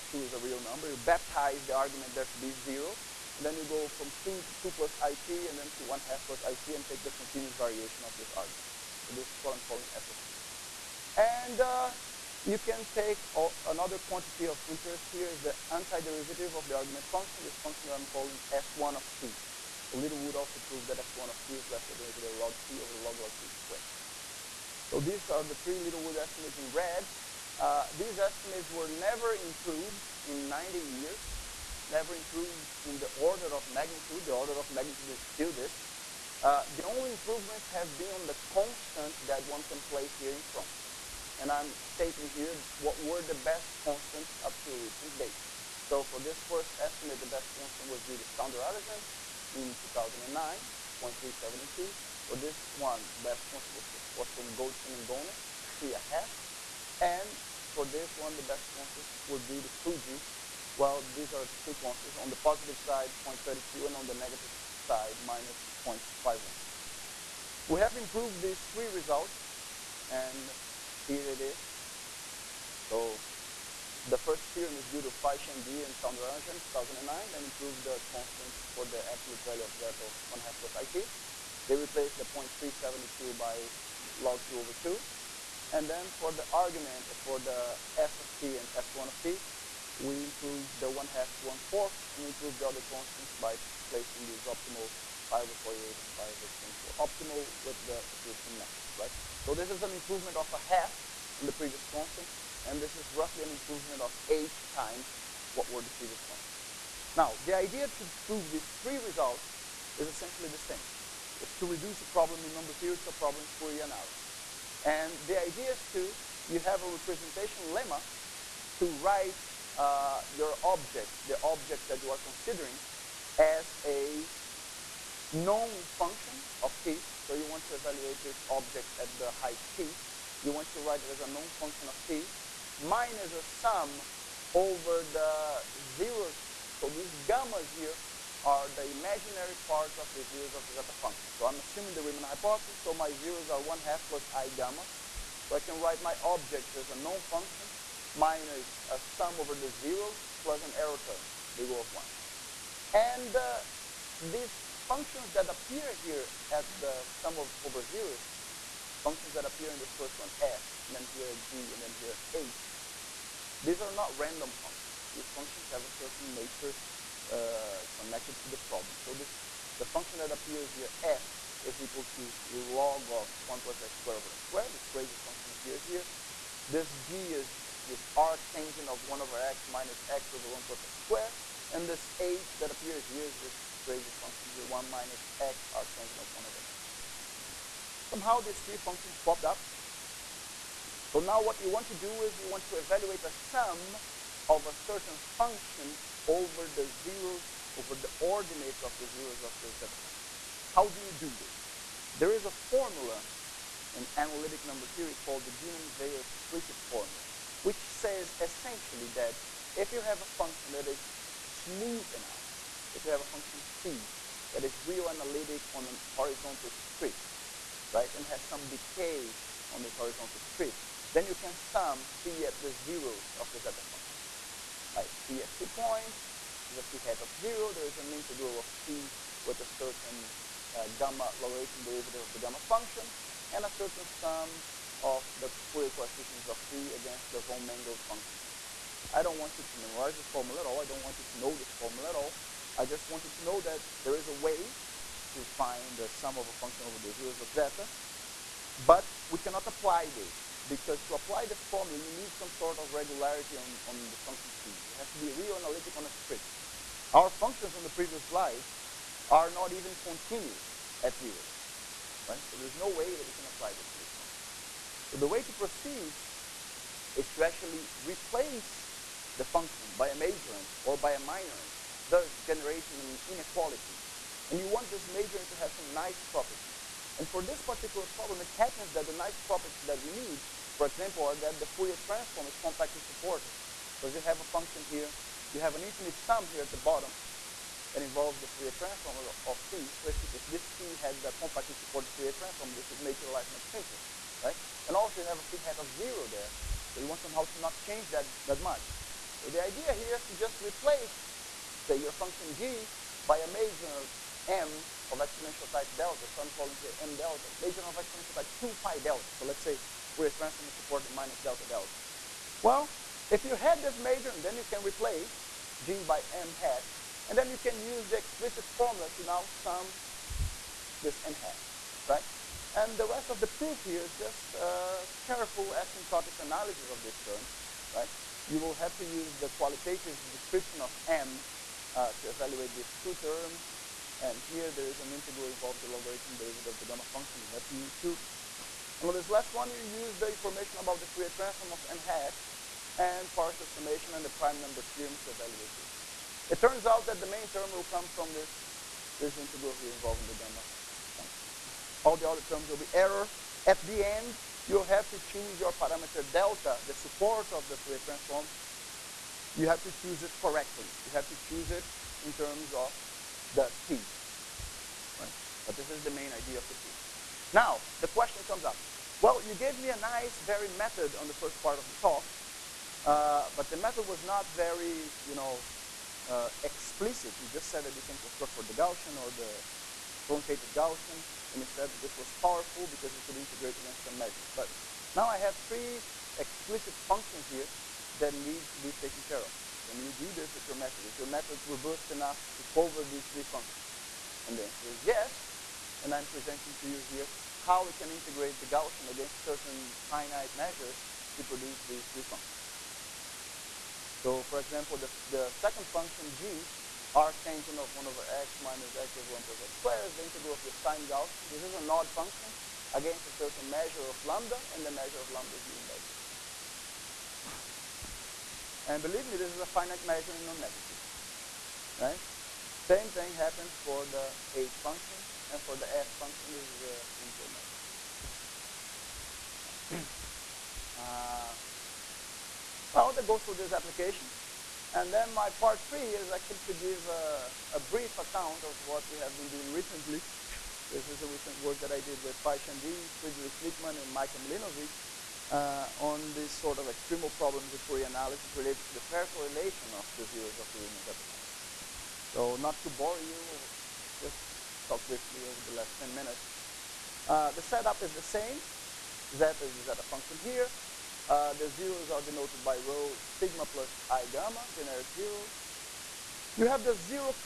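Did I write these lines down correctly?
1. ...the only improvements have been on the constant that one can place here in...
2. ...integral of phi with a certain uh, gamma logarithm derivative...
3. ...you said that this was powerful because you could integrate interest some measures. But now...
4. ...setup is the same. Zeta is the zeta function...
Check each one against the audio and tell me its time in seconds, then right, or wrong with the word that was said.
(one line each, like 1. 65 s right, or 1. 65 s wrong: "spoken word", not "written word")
1. 36 s right
2. 228 s right
3. 381 s wrong: "against", not "interest"
4. 457 s right.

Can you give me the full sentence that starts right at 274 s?
And you want this major to have some nice properties.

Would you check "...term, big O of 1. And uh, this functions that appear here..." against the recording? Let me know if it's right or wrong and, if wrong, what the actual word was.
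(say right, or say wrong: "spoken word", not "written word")
right.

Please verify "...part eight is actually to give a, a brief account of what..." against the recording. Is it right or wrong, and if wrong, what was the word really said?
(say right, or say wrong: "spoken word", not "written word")
wrong: "three", not "eight".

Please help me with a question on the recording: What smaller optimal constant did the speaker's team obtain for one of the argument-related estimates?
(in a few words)
pi/48.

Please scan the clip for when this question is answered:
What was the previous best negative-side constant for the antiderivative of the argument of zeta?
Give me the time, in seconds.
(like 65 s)
65 s.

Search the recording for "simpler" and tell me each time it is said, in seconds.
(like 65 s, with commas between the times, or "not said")
293 s, 427 s.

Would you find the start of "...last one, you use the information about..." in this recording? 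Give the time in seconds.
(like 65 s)
339 s.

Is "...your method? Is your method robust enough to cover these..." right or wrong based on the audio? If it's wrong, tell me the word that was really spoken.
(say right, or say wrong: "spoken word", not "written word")
right.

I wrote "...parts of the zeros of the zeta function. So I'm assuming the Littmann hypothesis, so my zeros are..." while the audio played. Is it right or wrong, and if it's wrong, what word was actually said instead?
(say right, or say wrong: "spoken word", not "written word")
wrong: "Riemann", not "Littmann".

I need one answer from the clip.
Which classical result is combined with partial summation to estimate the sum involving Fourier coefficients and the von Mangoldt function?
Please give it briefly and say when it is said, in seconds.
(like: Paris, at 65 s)
prime number theorem, at 344 s.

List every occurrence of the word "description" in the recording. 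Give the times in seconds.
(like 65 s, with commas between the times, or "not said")
330 s.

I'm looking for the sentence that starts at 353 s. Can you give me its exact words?
At the end, you have to choose your parameter delta, the support of the Fourier transform, you have to choose it correctly.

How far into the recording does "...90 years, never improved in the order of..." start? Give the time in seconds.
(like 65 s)
30 s.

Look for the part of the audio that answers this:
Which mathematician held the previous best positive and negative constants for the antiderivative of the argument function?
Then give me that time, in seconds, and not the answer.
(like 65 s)
59 s.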